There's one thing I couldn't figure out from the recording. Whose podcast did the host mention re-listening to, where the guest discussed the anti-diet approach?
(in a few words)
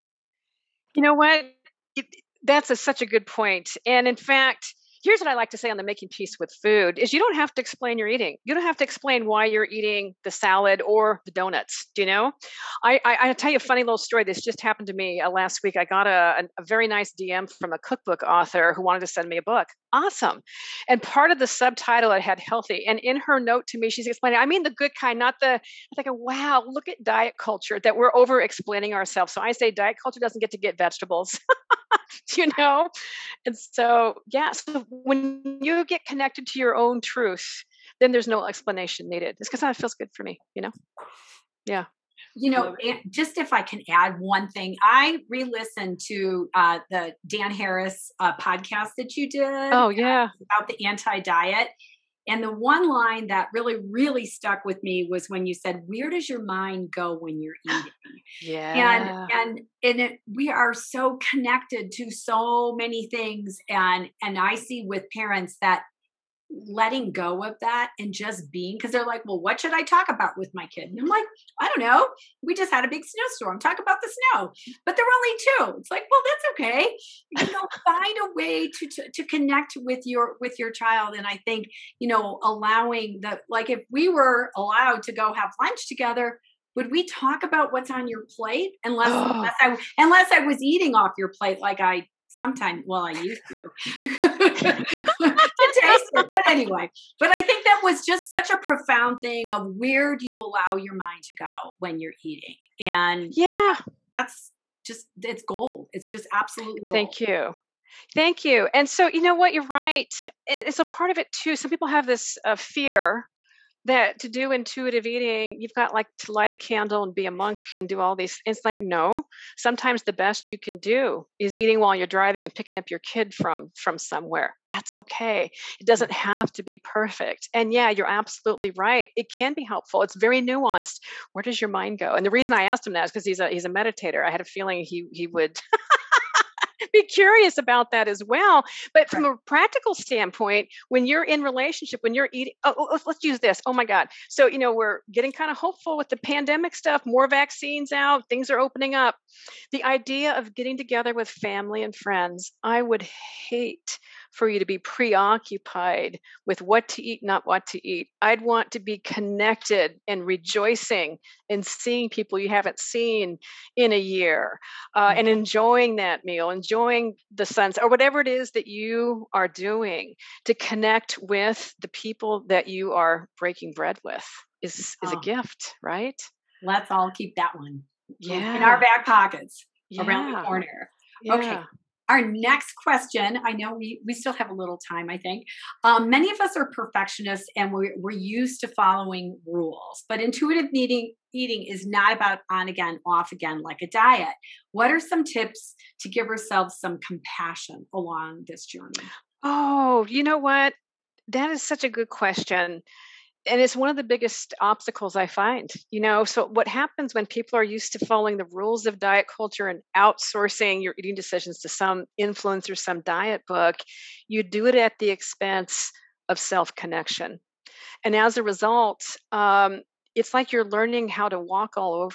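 Dan Harris.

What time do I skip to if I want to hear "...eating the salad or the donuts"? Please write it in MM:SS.
00:09.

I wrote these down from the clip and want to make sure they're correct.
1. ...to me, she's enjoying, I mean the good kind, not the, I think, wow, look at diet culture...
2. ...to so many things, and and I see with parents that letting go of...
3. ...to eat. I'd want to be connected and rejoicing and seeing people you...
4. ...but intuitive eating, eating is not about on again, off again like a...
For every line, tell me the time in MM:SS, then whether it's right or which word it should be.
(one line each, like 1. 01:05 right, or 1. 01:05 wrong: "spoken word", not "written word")
1. 00:23 wrong: "explaining", not "enjoying"
2. 01:01 right
3. 02:37 right
4. 03:10 right.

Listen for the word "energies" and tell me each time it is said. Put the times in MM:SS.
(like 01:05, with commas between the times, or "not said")
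not said.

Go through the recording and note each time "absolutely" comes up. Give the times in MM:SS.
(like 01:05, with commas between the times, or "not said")
01:46, 02:08.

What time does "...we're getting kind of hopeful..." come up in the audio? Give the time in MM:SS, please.
02:24.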